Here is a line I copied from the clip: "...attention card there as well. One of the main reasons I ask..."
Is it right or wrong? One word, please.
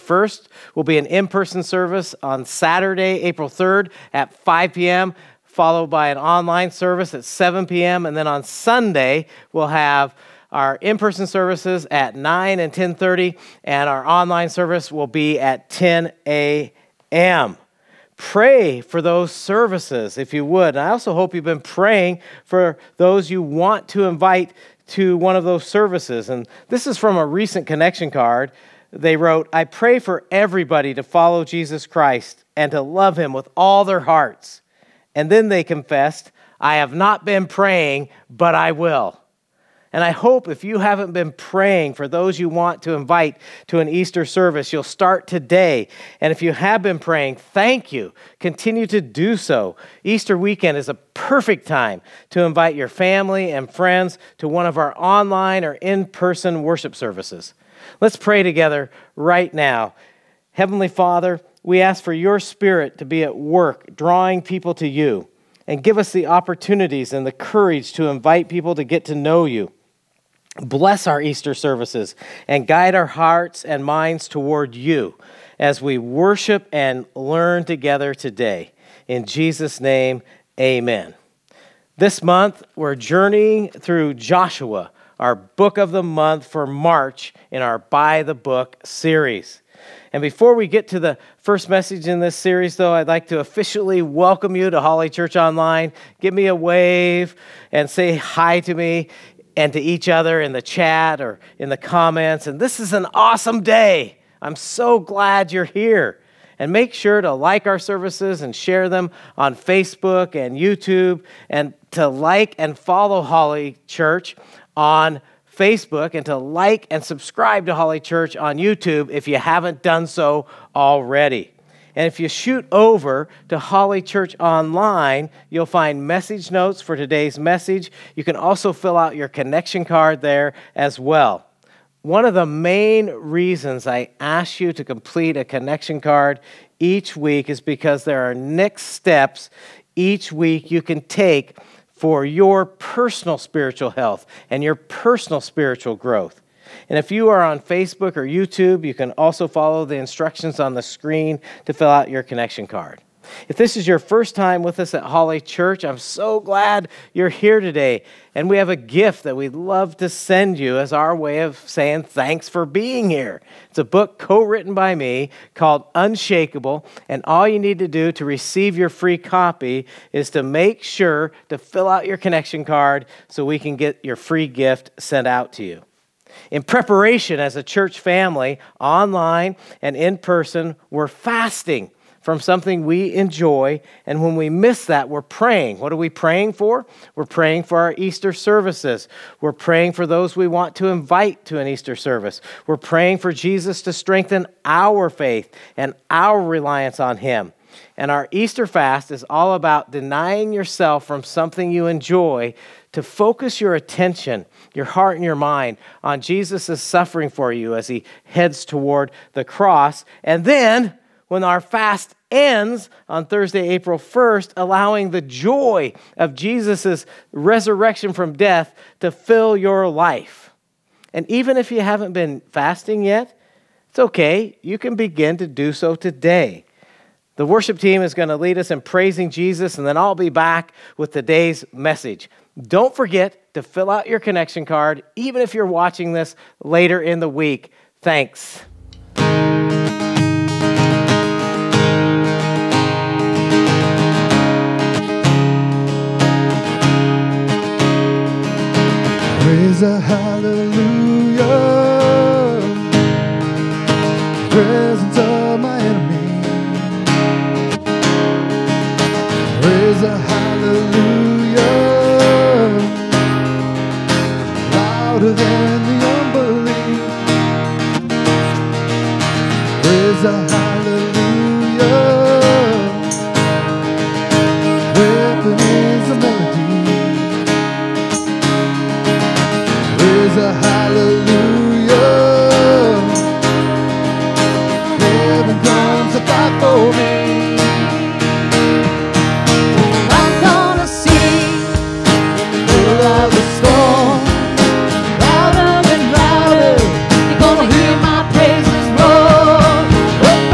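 wrong.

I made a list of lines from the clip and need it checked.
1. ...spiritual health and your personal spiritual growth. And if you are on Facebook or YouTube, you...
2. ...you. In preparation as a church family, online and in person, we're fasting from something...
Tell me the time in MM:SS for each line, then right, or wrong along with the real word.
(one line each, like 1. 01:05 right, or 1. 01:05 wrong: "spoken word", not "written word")
1. 02:23 right
2. 02:55 right.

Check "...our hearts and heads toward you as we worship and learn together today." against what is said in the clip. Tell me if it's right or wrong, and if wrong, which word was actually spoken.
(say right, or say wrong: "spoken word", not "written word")
wrong: "minds", not "heads".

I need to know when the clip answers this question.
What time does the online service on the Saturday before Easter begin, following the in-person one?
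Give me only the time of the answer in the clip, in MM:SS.
00:07.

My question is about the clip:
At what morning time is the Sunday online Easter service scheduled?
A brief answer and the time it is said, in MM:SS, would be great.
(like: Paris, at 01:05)
10 a.m., at 00:15.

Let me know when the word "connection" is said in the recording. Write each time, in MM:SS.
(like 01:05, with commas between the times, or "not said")
00:27, 02:09, 02:15, 02:32, 02:52, 03:54.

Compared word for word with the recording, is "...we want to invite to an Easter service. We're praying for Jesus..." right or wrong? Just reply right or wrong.
right.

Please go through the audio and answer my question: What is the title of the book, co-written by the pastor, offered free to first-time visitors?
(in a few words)
Unshakable.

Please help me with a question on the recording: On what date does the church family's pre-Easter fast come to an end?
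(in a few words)
Thursday, April 1st.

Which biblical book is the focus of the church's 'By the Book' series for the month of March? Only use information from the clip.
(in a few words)
Joshua.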